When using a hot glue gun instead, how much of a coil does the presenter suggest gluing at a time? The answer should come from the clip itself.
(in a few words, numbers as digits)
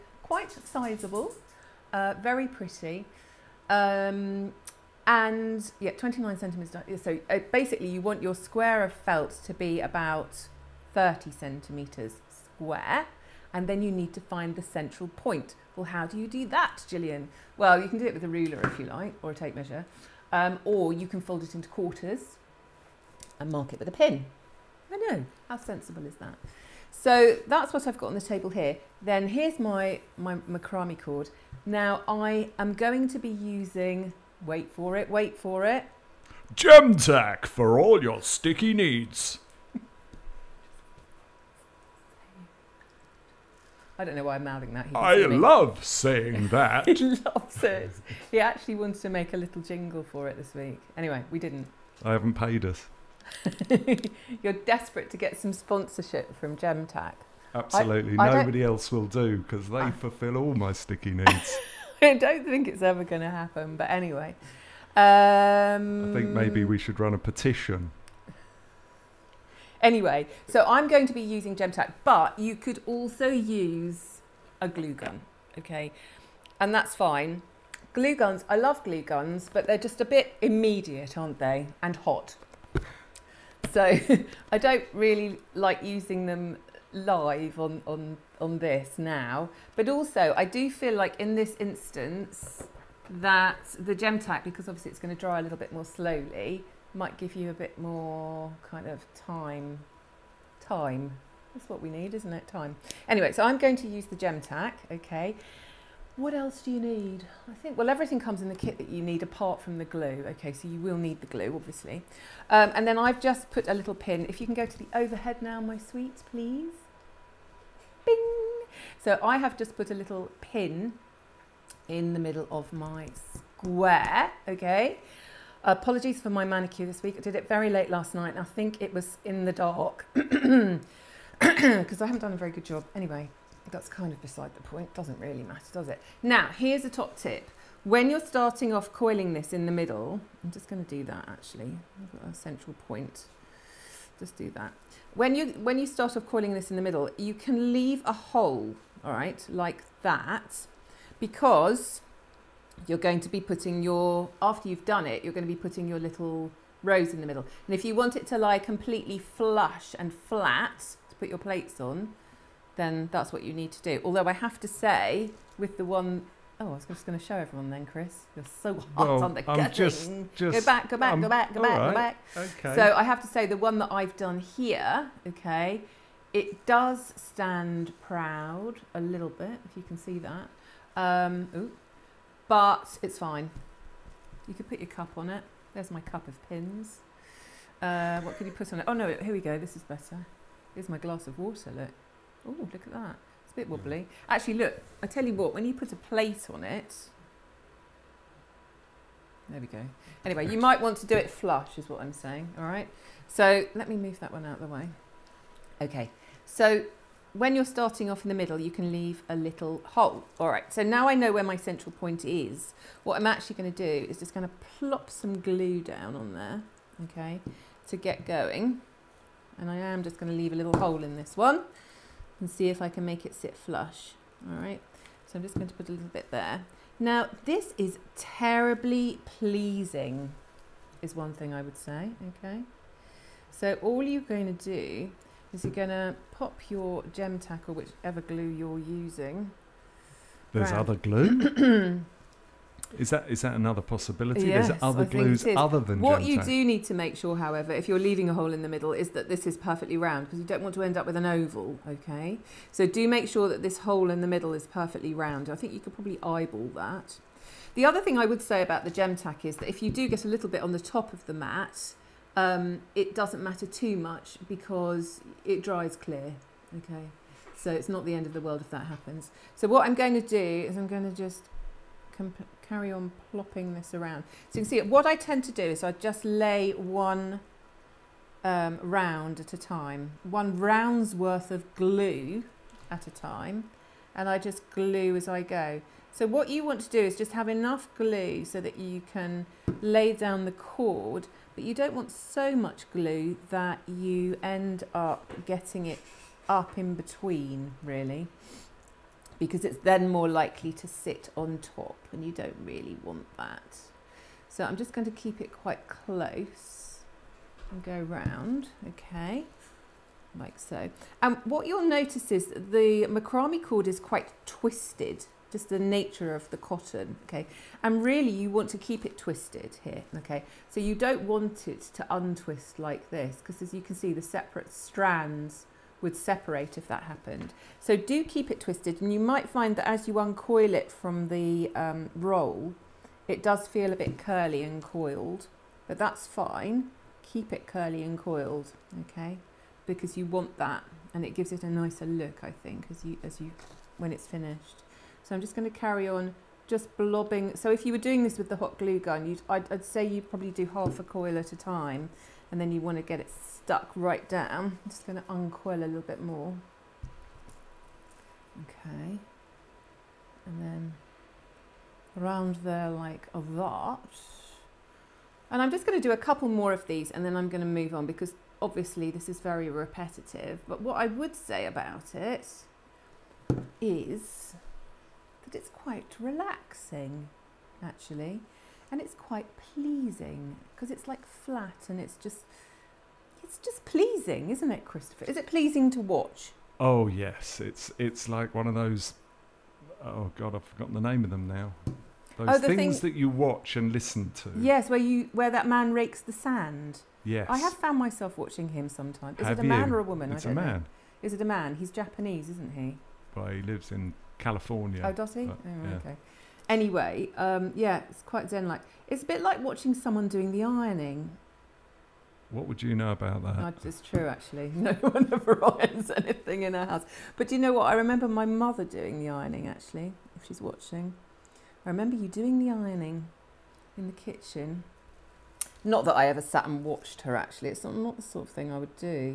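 Half a coil.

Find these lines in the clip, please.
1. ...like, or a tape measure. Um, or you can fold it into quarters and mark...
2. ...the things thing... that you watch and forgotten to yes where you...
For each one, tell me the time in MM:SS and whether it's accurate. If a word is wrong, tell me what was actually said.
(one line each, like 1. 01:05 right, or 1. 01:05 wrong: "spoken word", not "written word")
1. 00:18 right
2. 06:32 wrong: "listen", not "forgotten".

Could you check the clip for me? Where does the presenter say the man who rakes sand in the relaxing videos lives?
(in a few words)
California.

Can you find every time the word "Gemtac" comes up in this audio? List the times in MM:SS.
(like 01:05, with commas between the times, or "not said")
00:36, 00:56, 01:11, 01:33, 01:44.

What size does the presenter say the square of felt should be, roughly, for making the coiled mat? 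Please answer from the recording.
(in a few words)
30 centimetres.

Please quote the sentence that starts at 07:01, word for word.
I remember you doing the ironing in the kitchen.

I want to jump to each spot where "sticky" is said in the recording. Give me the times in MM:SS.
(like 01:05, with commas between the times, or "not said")
00:38, 01:00.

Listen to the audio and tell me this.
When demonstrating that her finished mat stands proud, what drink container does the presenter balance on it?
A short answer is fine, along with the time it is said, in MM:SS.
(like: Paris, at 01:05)
Glass of water, at 03:10.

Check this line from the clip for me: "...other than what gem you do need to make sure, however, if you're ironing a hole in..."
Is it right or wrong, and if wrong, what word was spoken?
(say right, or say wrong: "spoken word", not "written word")
wrong: "leaving", not "ironing".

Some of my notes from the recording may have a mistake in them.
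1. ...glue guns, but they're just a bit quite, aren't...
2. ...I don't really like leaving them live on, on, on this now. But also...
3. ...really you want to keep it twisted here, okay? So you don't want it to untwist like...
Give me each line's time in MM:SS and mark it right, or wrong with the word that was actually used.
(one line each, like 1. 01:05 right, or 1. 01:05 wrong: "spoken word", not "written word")
1. 01:18 wrong: "immediate", not "quite"
2. 01:24 wrong: "using", not "leaving"
3. 05:18 right.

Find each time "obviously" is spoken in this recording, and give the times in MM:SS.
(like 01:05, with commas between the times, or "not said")
01:34, 01:51, 06:08.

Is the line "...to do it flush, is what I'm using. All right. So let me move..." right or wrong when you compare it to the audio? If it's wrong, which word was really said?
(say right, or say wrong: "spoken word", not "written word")
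wrong: "saying", not "using".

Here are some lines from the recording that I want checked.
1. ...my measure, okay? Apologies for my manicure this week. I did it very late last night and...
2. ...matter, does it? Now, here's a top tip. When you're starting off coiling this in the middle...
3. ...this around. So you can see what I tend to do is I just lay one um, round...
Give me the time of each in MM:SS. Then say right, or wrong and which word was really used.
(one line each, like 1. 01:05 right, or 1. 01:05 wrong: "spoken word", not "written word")
1. 02:02 wrong: "square", not "measure"
2. 02:15 right
3. 04:33 right.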